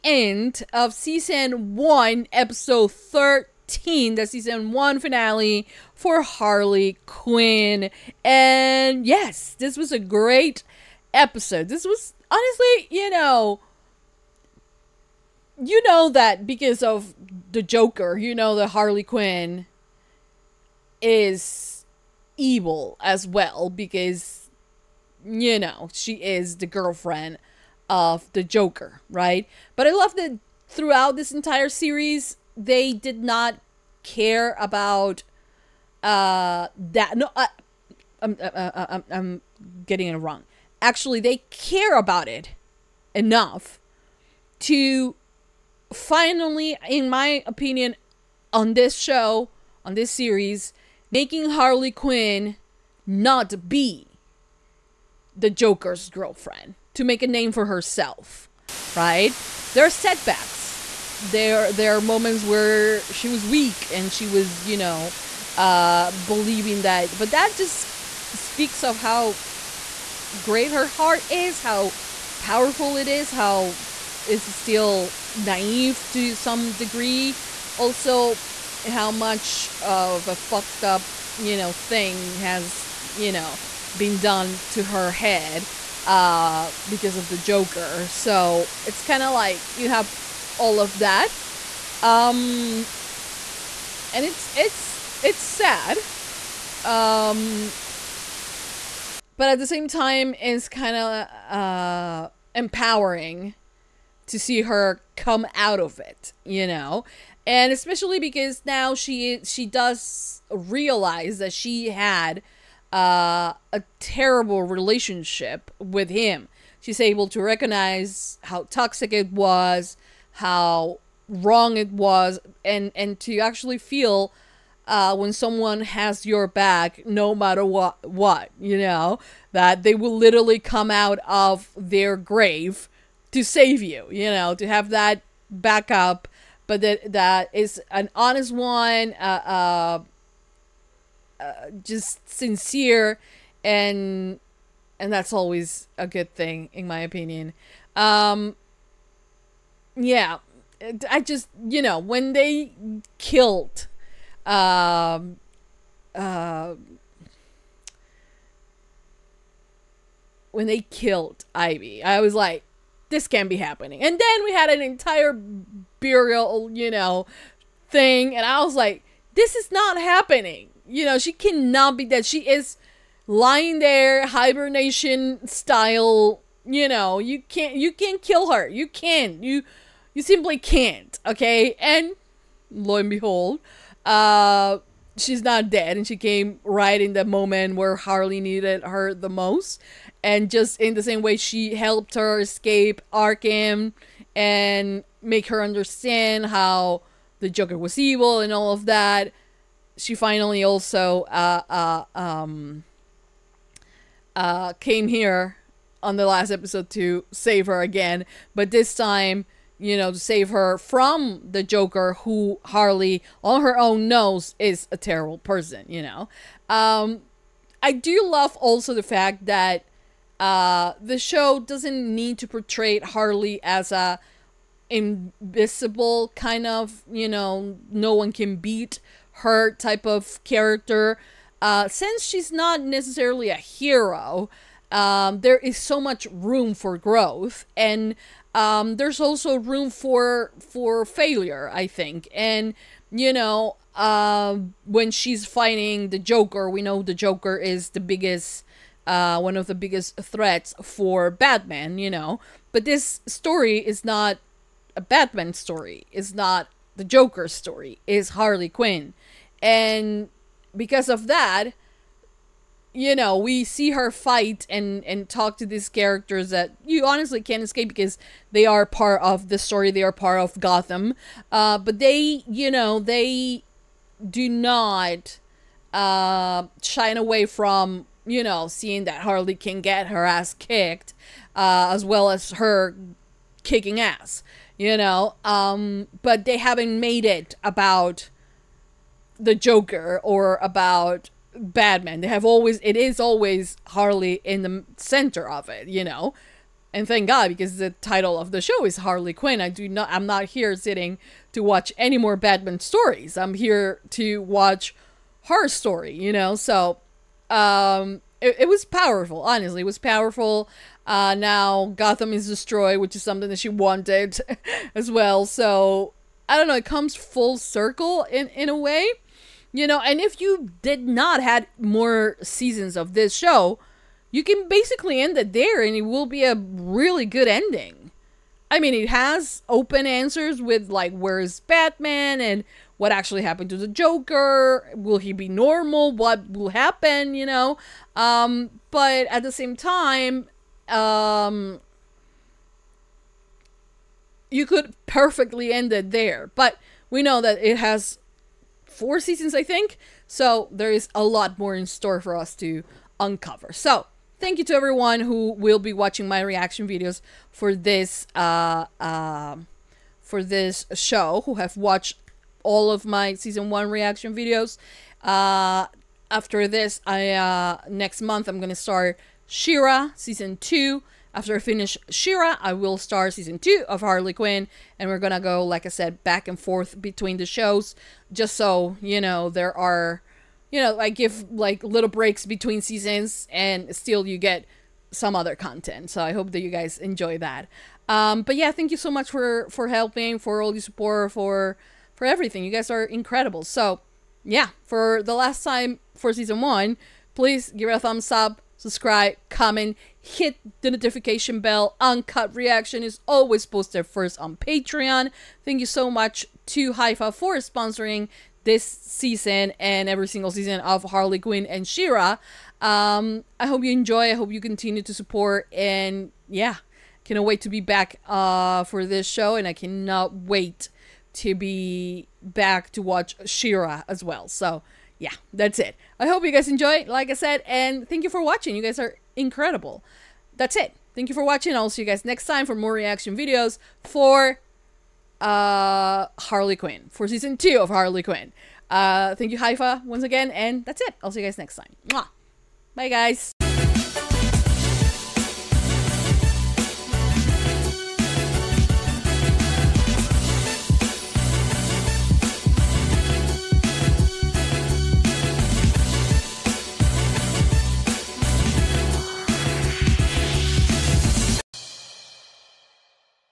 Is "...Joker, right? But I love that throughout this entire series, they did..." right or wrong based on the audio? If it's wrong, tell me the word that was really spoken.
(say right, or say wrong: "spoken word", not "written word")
right.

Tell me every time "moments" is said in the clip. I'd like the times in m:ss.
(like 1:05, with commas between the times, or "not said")
1:02, 3:07.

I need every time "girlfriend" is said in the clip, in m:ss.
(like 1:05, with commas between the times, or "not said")
0:26, 0:56.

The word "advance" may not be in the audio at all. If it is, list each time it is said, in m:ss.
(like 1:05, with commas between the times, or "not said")
not said.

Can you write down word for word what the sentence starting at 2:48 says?
And I was like, this is not happening.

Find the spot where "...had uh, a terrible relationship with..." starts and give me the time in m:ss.
1:51.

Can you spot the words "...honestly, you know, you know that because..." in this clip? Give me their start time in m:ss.
0:12.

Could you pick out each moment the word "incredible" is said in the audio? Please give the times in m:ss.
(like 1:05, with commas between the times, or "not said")
6:33, 7:09.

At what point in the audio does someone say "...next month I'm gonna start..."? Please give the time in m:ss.
6:07.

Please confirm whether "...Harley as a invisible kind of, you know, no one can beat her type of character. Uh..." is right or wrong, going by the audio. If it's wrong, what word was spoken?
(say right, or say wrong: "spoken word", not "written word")
right.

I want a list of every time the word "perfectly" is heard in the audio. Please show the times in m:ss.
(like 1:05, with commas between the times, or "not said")
5:45.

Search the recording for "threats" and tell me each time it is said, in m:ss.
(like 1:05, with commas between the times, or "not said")
4:10.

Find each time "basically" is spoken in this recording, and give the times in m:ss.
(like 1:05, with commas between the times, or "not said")
5:24.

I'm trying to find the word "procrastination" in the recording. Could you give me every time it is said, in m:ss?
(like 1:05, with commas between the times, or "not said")
not said.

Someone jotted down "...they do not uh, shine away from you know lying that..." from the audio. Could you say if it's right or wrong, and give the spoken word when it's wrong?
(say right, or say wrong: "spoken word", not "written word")
wrong: "seeing", not "lying".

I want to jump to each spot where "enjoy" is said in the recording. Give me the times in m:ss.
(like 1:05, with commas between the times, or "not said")
6:26, 6:53, 7:06.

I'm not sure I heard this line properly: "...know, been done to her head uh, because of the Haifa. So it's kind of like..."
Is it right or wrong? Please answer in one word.
wrong.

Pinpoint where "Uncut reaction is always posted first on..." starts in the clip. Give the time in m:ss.
6:42.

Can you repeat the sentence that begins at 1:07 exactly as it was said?
But that just speaks of how great her heart is, how powerful it is, how it's still naive to some degree.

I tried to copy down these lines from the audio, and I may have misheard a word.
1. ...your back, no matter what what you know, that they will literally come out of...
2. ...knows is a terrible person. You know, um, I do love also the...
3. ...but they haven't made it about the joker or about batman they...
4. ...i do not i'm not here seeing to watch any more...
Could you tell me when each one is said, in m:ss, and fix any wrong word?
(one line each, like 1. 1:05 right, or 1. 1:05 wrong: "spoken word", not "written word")
1. 2:06 right
2. 3:34 right
3. 4:46 right
4. 4:59 wrong: "sitting", not "seeing".